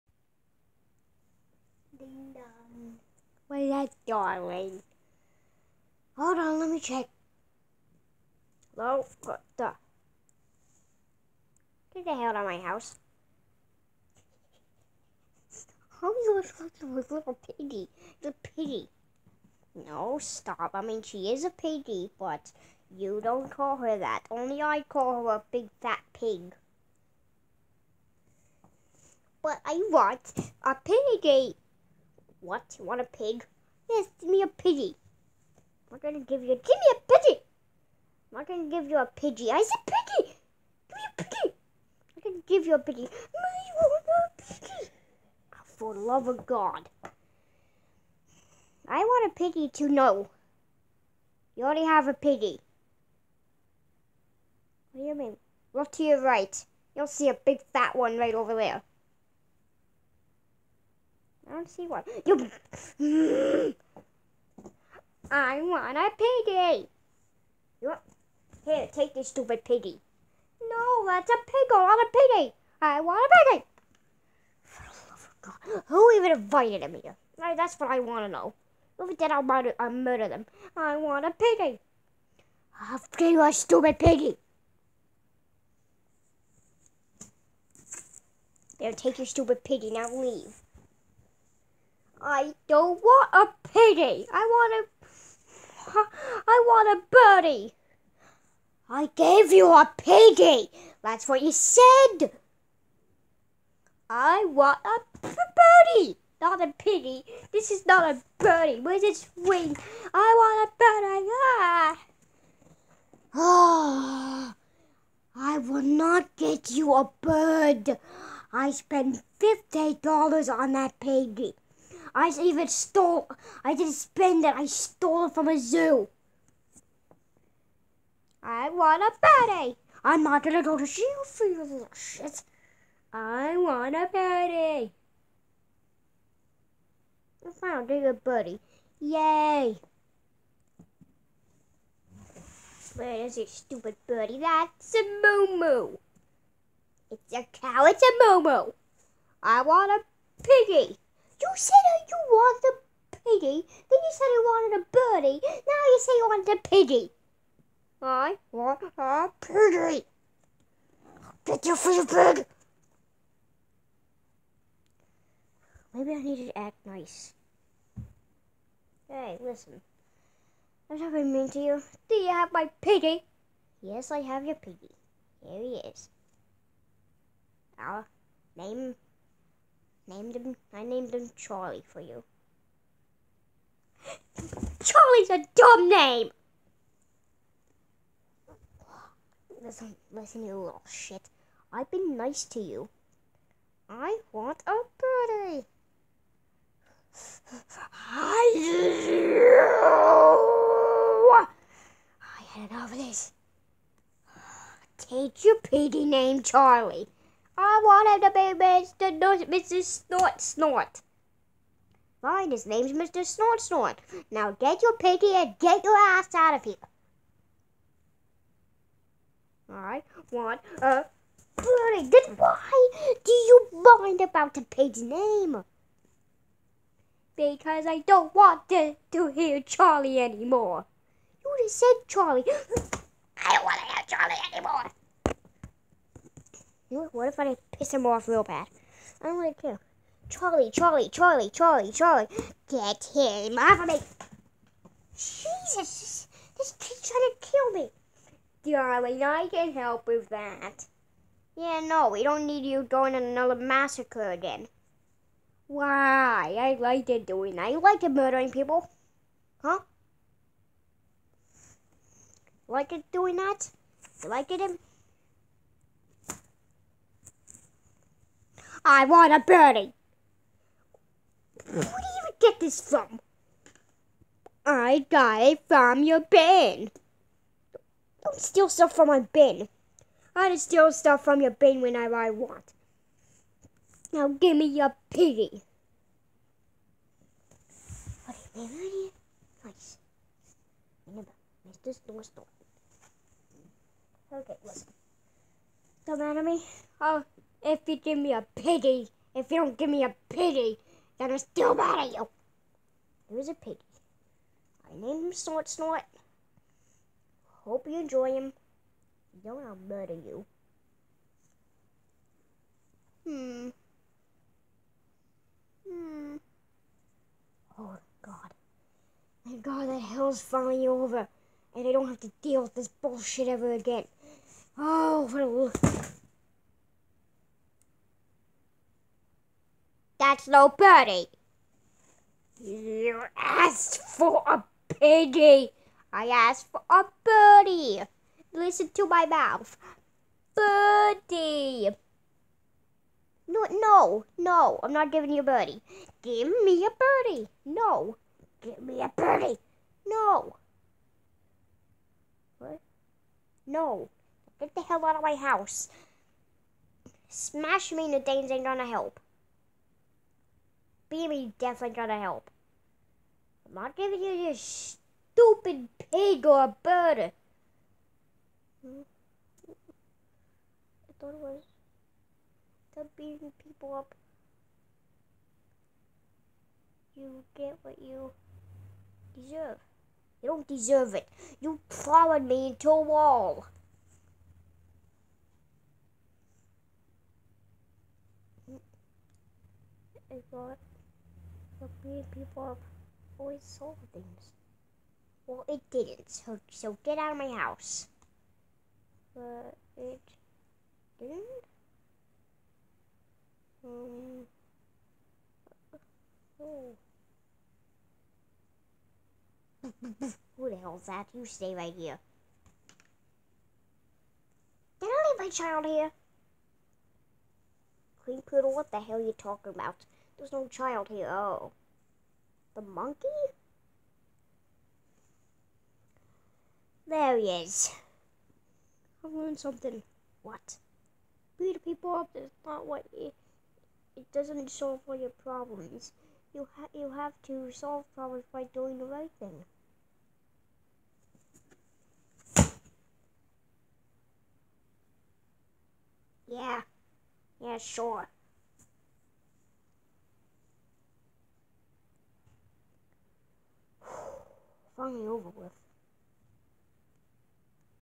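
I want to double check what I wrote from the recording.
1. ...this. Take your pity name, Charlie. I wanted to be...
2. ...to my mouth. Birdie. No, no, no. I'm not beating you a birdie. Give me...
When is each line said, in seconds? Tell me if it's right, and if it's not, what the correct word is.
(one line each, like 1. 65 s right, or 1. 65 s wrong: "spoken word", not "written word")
1. 202 s right
2. 338 s wrong: "giving", not "beating".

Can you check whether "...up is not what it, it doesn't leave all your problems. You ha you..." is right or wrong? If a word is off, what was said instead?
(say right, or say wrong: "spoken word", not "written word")
wrong: "solve", not "leave".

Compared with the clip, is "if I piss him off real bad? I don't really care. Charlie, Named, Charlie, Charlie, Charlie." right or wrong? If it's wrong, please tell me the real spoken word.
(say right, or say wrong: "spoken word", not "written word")
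wrong: "Charlie", not "Named".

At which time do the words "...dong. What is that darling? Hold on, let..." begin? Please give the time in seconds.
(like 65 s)
2 s.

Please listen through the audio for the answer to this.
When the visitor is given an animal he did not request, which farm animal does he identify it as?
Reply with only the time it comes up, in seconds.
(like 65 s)
147 s.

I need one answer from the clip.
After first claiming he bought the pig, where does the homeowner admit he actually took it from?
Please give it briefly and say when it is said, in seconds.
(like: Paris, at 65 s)
a zoo, at 125 s.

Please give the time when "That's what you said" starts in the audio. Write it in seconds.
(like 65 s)
101 s.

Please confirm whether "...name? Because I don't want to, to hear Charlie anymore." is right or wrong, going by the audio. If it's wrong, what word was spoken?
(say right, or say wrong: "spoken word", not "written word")
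right.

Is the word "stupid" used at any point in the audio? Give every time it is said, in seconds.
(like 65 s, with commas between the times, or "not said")
69 s, 83 s, 89 s, 143 s, 365 s.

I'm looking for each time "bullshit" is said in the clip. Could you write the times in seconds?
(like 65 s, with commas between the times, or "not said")
322 s.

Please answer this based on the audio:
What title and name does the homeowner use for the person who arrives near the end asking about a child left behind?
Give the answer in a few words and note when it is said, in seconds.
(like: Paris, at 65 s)
Queen Poodle, at 418 s.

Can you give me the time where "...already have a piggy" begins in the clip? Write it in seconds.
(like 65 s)
51 s.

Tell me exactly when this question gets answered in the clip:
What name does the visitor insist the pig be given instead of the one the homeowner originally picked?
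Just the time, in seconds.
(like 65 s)
212 s.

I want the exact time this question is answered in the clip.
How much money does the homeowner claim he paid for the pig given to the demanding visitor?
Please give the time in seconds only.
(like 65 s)
119 s.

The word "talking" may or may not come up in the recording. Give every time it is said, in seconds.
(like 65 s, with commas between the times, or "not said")
16 s, 419 s.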